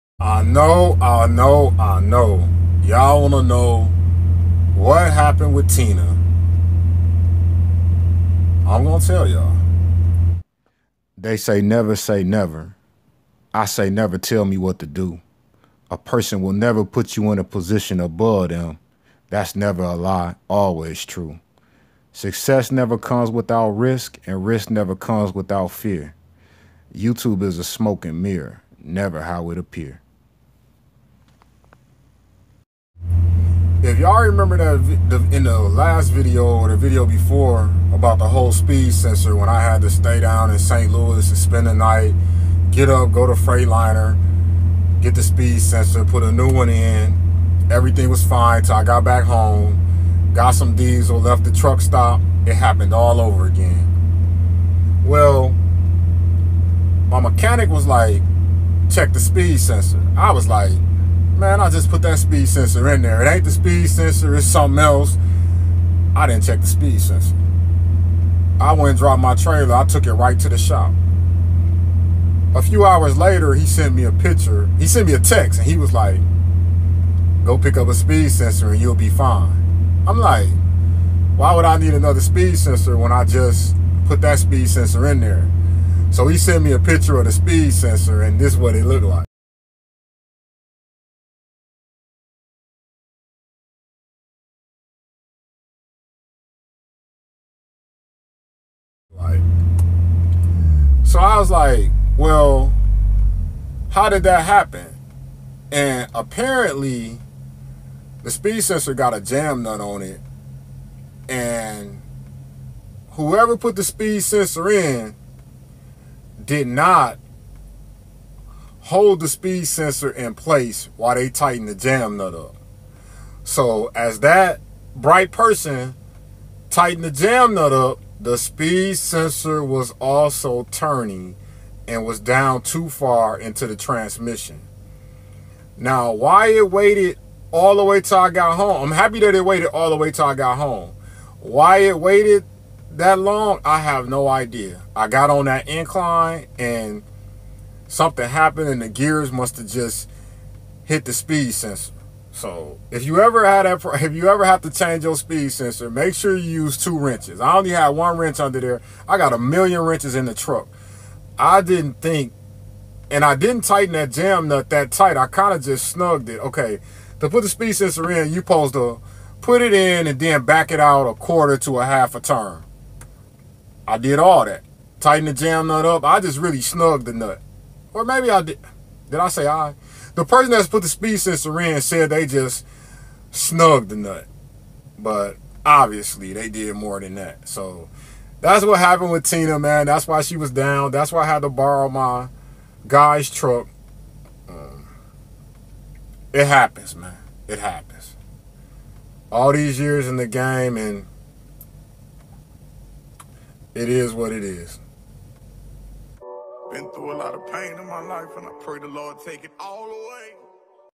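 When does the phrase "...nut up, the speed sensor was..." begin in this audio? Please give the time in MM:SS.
02:07.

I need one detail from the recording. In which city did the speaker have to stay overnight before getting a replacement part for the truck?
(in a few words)
St. Louis.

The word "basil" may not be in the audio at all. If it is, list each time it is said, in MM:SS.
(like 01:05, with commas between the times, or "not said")
not said.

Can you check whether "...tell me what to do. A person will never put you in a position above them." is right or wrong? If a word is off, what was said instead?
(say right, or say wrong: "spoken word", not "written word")
right.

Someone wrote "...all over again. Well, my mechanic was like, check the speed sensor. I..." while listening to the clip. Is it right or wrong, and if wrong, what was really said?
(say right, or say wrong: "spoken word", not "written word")
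right.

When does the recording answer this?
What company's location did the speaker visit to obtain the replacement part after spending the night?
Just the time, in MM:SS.
00:43.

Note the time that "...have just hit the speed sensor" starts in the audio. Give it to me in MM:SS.
02:29.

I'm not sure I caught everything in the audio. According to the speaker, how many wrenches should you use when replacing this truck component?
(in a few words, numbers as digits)
2.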